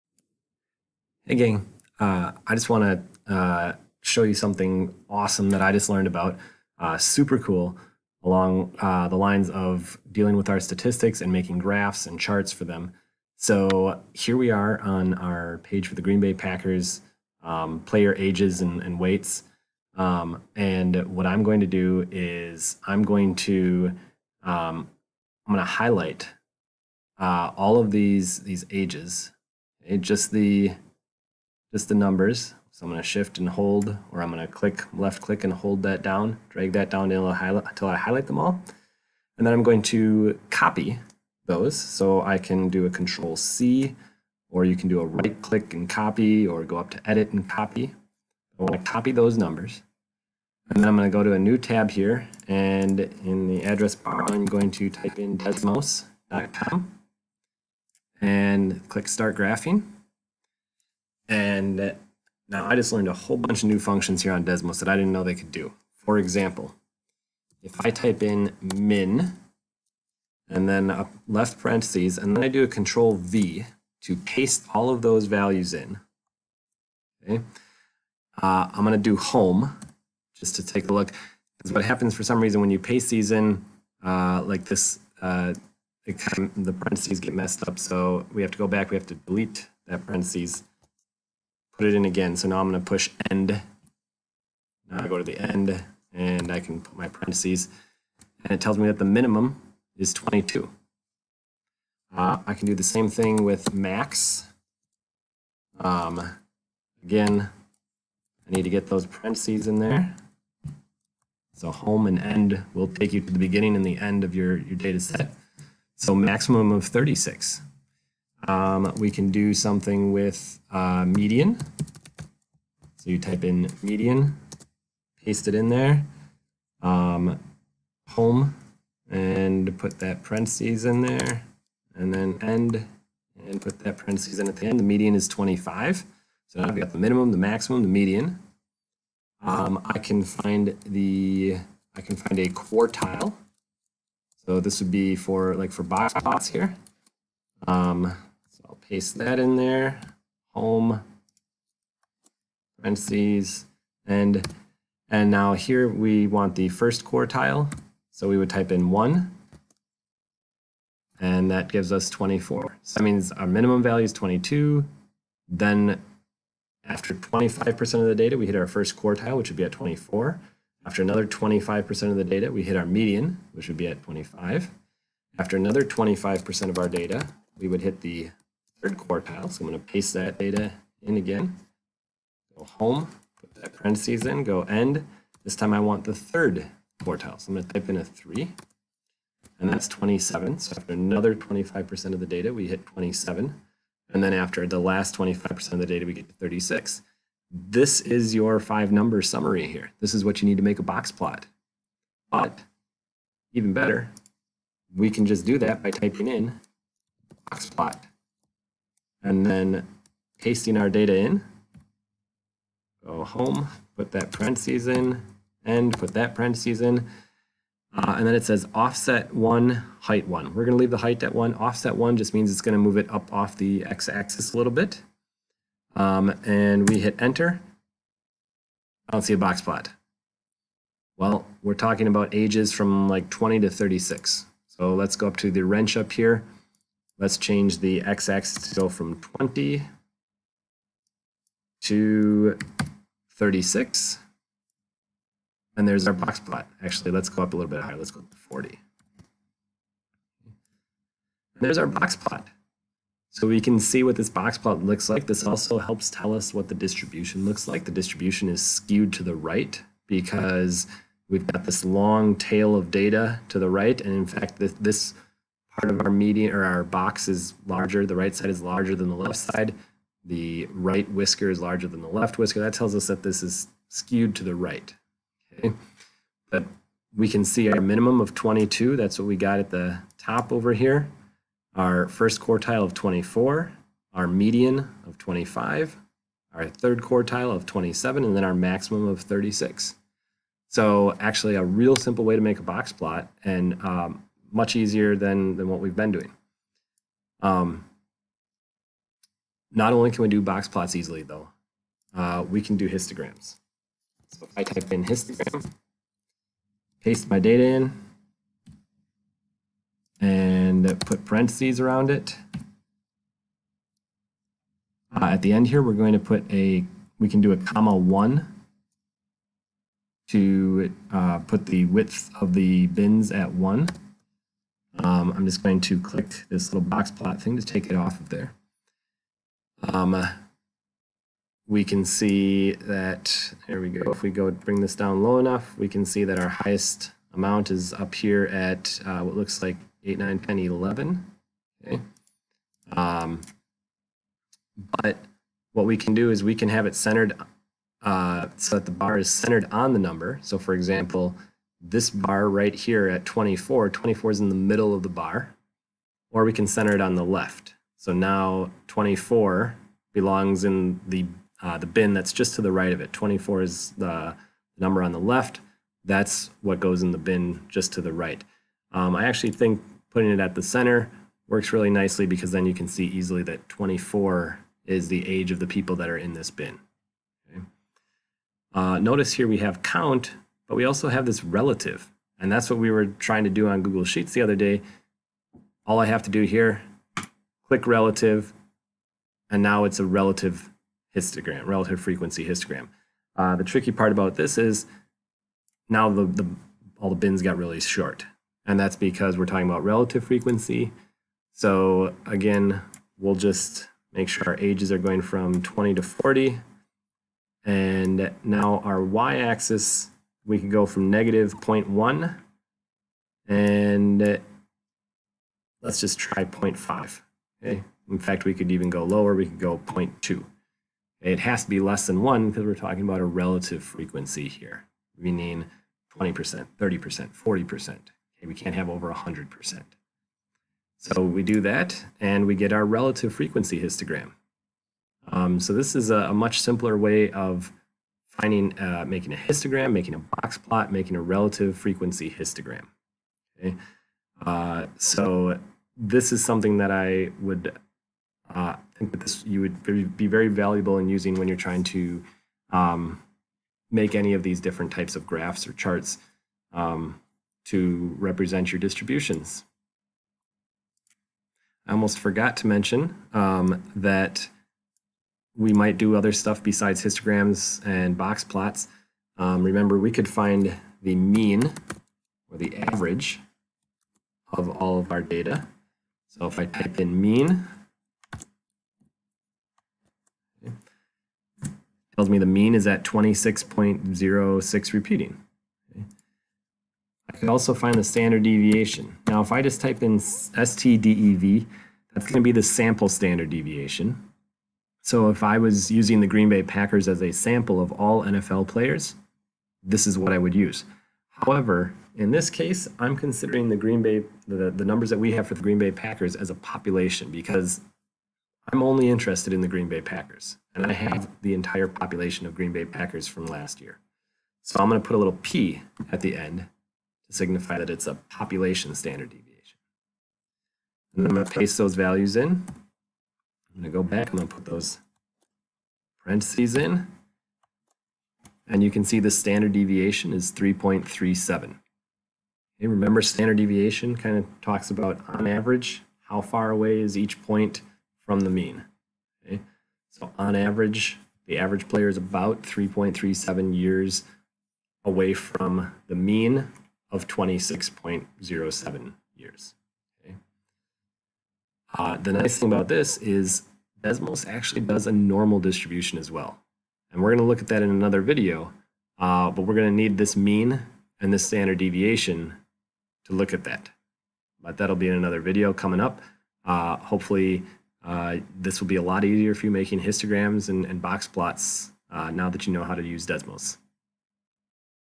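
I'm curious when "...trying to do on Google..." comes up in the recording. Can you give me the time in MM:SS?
06:23.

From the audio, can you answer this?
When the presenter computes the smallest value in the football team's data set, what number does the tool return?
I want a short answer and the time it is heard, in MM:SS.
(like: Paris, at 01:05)
22, at 01:38.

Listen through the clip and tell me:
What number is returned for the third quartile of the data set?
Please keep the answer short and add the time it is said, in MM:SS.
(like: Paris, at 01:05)
27, at 03:09.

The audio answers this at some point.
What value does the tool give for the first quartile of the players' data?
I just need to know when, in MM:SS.
02:41.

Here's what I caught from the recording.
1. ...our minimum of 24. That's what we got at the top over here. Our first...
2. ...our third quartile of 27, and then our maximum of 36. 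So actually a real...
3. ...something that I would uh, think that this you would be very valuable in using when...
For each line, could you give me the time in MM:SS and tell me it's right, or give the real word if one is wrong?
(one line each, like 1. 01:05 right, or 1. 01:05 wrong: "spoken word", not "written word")
1. 04:37 wrong: "22", not "24"
2. 04:46 right
3. 07:26 right.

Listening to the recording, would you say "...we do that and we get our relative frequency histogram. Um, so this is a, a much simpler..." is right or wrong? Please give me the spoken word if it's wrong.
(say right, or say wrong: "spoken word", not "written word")
right.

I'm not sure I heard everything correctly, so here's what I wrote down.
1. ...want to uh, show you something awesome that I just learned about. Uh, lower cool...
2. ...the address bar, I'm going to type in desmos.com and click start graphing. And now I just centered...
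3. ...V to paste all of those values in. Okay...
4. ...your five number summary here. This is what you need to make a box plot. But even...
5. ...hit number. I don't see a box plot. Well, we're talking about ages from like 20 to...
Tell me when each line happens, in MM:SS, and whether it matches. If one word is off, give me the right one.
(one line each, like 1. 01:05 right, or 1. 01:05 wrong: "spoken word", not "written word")
1. 00:02 wrong: "super", not "lower"
2. 00:53 wrong: "learned", not "centered"
3. 01:13 right
4. 03:18 right
5. 03:46 wrong: "enter", not "number".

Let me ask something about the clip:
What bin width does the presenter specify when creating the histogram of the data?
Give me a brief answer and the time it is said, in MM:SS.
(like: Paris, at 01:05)
1, at 05:17.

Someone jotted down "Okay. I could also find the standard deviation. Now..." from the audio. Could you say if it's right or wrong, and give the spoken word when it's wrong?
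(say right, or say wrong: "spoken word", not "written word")
right.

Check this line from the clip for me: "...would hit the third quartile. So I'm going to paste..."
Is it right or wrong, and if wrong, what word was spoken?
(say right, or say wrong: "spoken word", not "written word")
right.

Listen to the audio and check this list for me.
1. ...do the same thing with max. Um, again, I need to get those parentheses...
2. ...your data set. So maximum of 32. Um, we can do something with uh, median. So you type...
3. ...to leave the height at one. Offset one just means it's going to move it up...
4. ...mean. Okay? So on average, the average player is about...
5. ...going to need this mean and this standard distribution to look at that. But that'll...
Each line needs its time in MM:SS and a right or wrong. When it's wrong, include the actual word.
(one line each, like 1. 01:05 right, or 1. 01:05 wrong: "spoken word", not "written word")
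1. 01:42 right
2. 01:54 wrong: "36", not "32"
3. 03:40 right
4. 08:58 right
5. 09:19 wrong: "deviation", not "distribution".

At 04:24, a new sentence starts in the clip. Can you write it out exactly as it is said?
And in fact, this, this part of our median or our box is larger.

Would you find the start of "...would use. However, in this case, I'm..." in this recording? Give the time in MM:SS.
08:20.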